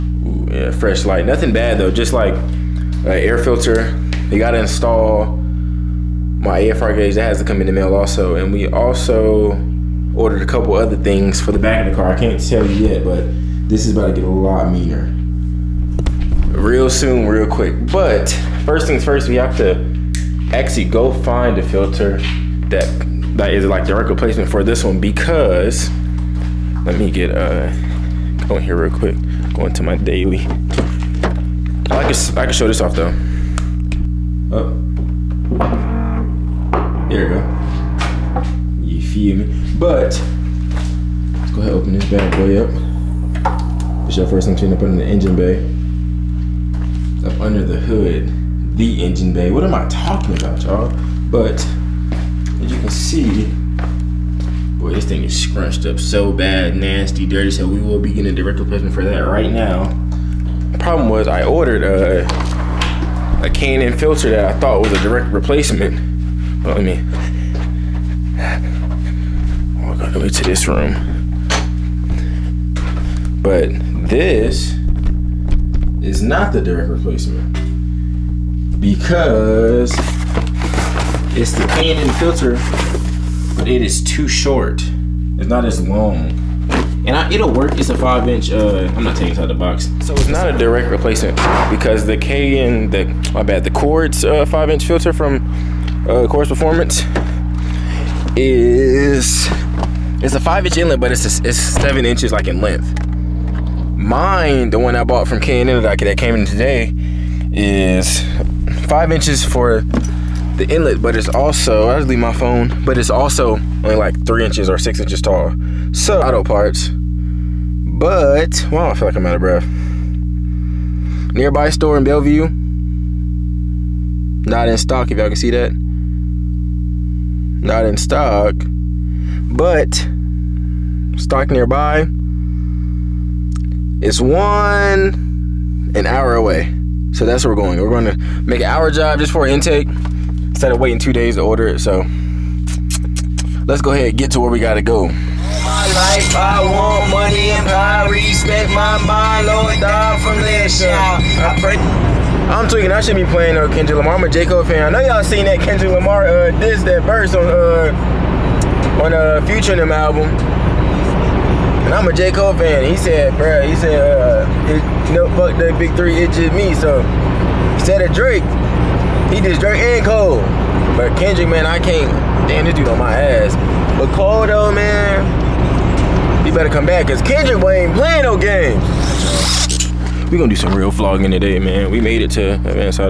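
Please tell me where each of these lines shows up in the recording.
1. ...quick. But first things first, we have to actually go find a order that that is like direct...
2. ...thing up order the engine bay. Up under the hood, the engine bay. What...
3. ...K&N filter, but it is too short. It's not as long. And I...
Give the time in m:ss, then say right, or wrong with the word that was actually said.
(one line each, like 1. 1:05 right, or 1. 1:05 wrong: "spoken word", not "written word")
1. 0:17 wrong: "filter", not "order"
2. 0:44 wrong: "under", not "order"
3. 1:21 right.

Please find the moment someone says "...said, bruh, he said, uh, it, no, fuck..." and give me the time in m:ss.
2:42.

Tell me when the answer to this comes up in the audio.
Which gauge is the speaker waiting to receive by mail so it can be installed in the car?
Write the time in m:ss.
0:06.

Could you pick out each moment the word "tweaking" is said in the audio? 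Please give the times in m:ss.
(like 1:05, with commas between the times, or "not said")
2:32.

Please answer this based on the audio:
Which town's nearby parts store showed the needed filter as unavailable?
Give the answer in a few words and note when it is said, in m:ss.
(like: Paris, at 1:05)
Bellevue, at 2:02.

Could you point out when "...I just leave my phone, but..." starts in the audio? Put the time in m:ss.
1:51.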